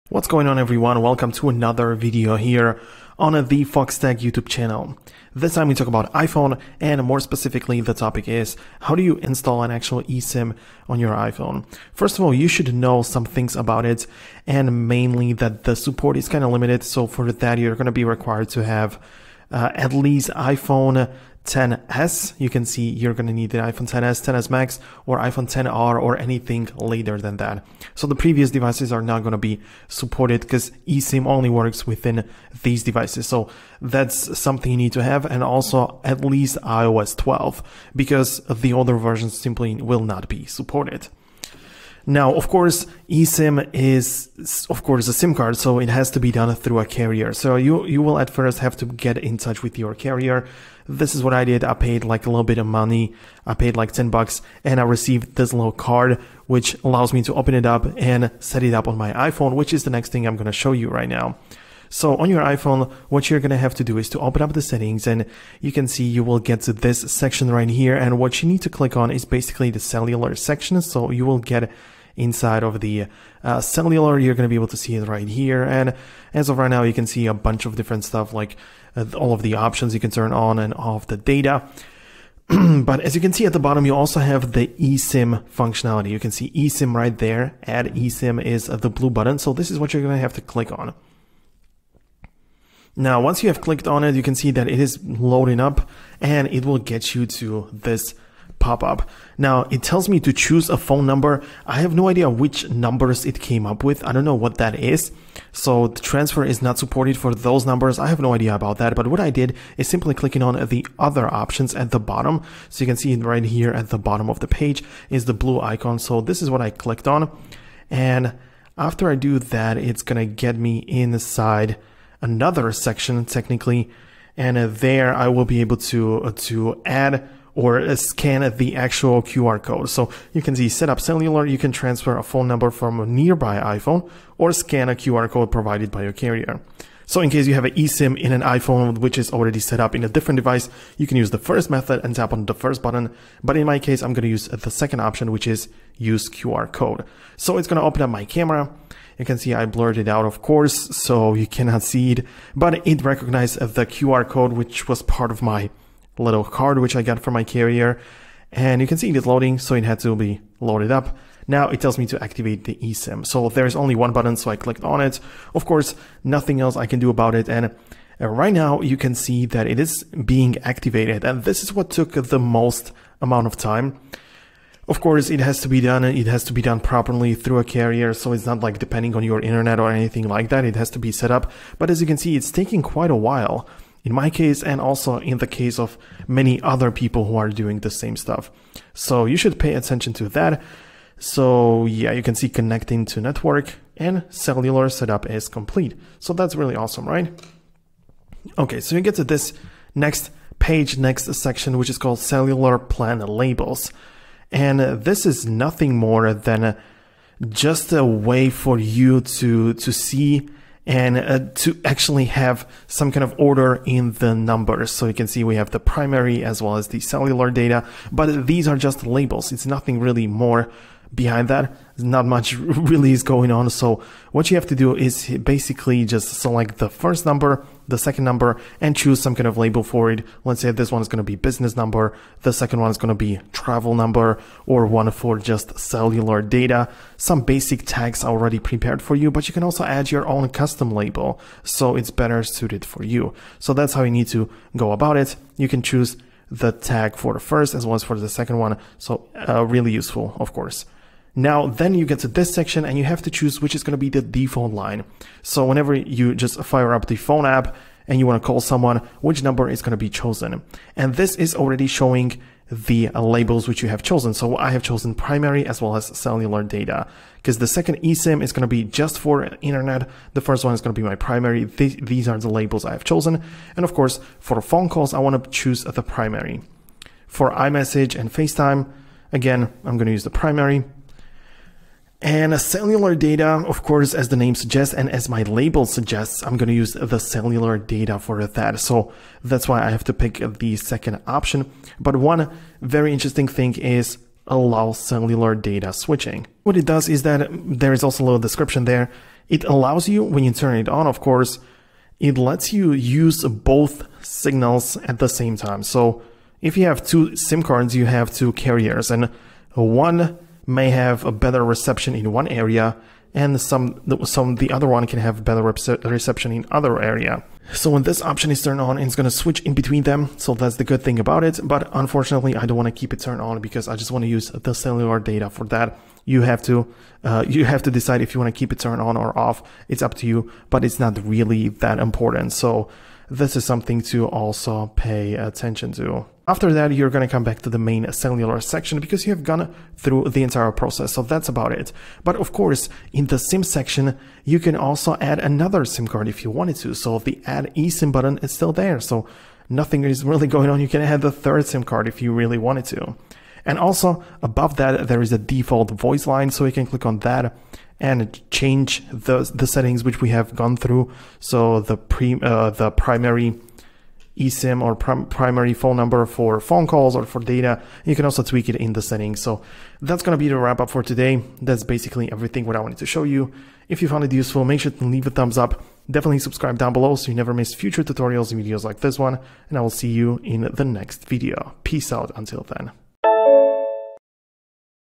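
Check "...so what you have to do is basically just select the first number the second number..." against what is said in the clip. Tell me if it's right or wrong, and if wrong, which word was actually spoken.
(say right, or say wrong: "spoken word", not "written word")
right.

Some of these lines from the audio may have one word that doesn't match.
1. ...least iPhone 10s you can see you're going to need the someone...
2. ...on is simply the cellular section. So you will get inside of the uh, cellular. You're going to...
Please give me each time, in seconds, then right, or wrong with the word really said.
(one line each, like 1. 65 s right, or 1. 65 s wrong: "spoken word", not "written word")
1. 19 s wrong: "iphone", not "someone"
2. 68 s wrong: "basically", not "simply".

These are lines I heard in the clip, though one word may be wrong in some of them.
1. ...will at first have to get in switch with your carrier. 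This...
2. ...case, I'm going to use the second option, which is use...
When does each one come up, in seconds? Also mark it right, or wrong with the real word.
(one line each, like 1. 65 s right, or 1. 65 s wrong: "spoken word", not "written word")
1. 48 s wrong: "touch", not "switch"
2. 143 s right.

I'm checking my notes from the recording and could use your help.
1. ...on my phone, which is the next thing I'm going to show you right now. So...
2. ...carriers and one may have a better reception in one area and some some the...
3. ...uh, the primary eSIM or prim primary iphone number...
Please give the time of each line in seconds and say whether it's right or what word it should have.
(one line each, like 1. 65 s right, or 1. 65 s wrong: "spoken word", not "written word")
1. 58 s wrong: "iPhone", not "phone"
2. 308 s right
3. 362 s wrong: "phone", not "iphone".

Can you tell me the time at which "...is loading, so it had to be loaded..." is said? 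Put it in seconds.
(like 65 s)
159 s.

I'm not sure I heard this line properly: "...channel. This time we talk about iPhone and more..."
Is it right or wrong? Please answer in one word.
right.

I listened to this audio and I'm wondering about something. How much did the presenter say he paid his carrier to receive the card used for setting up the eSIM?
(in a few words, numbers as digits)
10 bucks.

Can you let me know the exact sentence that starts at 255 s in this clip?
So whenever you just fire up the phone app and you want to call someone, which number is going to be chosen.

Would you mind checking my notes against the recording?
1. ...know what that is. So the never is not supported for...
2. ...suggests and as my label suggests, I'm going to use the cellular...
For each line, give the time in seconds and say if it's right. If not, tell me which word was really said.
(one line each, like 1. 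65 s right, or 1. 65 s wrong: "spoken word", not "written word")
1. 104 s wrong: "transfer", not "never"
2. 284 s right.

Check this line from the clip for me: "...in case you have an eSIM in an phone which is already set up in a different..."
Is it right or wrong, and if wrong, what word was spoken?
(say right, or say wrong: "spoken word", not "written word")
wrong: "iPhone", not "phone".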